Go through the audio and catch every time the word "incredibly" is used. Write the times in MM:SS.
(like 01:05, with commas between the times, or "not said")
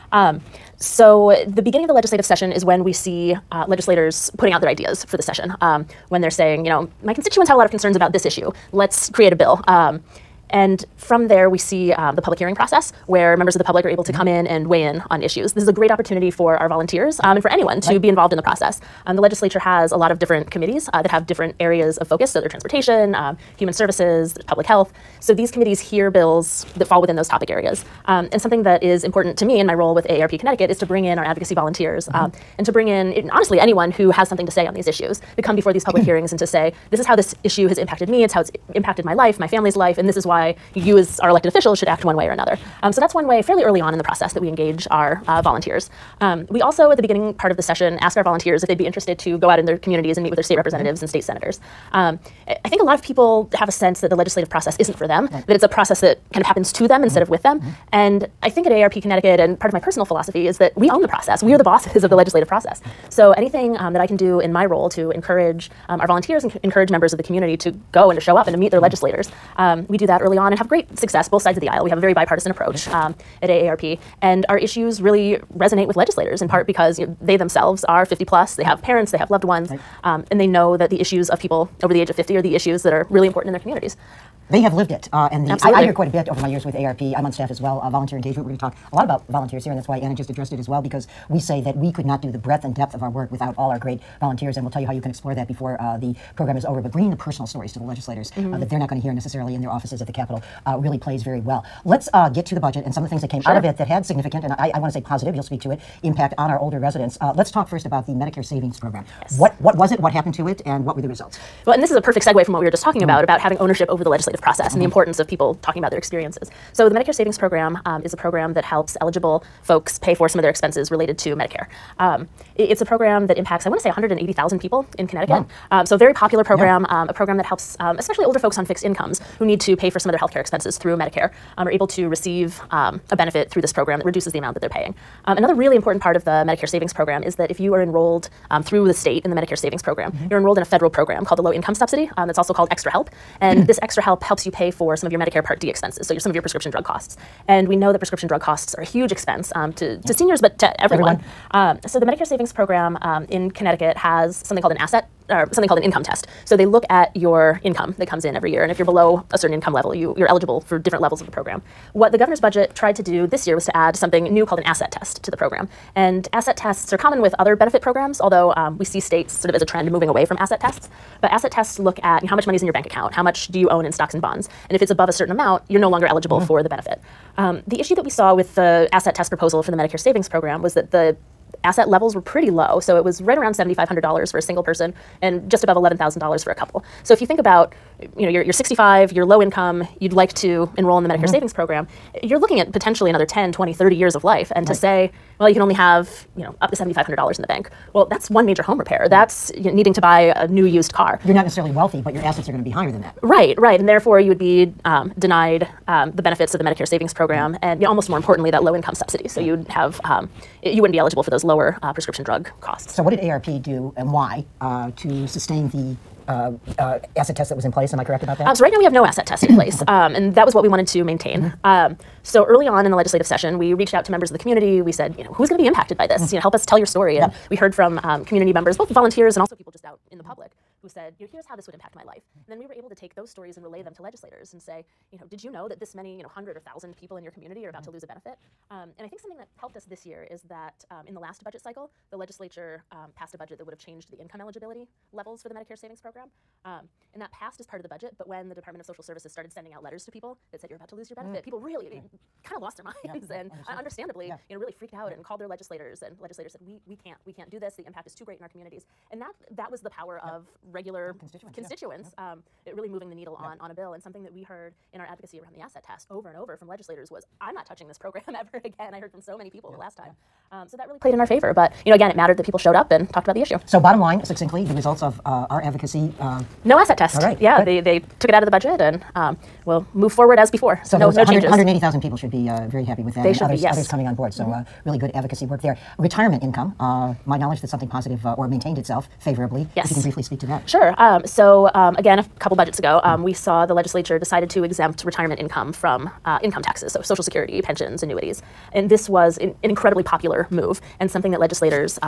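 04:59.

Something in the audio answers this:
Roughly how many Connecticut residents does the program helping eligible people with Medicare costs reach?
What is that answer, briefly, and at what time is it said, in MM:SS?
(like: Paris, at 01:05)
180,000, at 02:03.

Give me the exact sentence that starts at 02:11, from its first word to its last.
Um, are able to receive um, a benefit through this program that reduces the amount that they're paying.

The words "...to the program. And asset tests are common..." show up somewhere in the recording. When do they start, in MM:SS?
02:45.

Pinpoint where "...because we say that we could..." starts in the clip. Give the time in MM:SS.
01:30.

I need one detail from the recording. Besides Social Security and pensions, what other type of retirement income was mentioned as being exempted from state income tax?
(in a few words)
Annuities.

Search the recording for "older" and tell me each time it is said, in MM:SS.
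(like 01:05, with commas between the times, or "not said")
01:46, 02:08.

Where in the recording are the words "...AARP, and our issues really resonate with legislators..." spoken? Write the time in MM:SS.
01:13.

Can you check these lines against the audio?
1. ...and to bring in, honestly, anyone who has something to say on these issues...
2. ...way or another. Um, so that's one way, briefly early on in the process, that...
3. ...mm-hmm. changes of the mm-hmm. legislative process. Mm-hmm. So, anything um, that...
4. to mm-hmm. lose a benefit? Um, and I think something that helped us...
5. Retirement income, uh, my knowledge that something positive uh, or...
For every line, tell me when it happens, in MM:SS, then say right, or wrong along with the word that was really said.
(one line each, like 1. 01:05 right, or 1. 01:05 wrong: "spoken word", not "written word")
1. 00:32 right
2. 00:42 wrong: "fairly", not "briefly"
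3. 01:01 wrong: "bosses", not "changes"
4. 03:57 right
5. 04:45 right.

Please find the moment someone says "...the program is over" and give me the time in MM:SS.
01:35.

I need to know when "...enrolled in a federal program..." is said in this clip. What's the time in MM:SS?
02:20.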